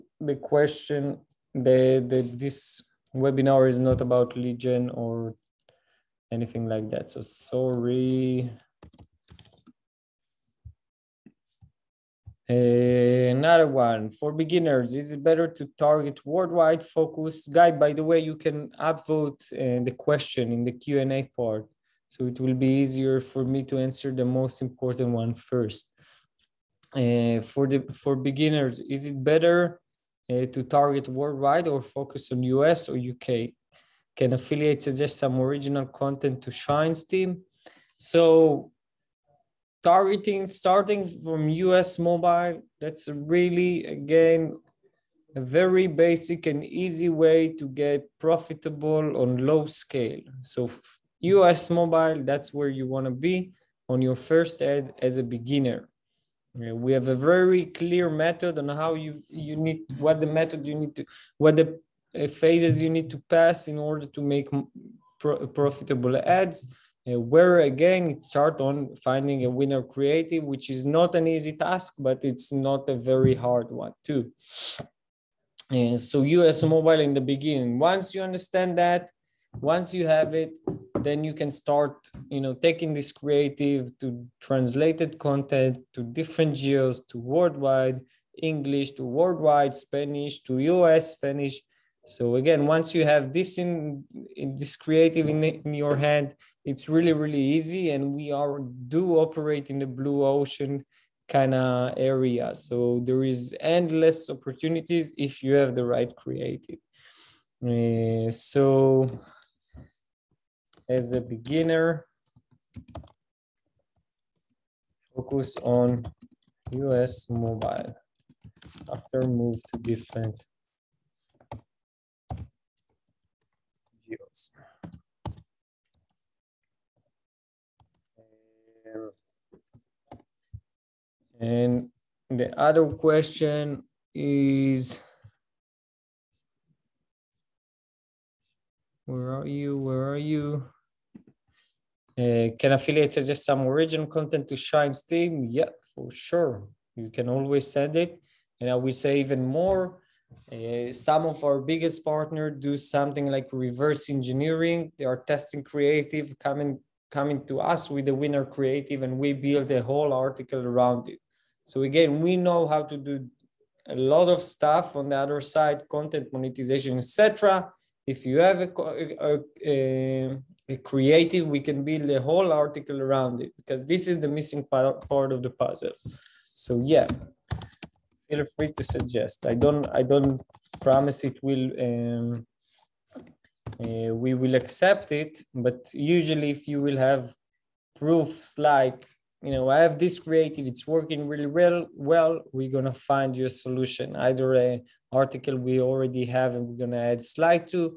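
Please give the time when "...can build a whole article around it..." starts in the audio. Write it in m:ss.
2:51.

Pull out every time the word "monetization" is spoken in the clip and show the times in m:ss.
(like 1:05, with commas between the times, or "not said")
2:46.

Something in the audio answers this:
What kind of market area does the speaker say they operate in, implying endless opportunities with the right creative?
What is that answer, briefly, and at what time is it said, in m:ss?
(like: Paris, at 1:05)
blue ocean, at 1:39.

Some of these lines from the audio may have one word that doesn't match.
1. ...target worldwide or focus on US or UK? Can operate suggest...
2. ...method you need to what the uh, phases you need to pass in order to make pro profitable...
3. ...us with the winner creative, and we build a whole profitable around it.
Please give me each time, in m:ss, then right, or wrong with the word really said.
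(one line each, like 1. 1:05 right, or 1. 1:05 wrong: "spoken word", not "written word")
1. 0:30 wrong: "affiliate", not "operate"
2. 1:00 right
3. 2:37 wrong: "article", not "profitable".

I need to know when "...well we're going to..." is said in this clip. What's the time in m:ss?
3:11.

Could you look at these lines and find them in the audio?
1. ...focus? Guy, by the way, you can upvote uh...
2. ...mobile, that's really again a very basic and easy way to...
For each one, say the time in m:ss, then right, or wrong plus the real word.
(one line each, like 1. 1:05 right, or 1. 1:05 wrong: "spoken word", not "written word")
1. 0:16 right
2. 0:41 right.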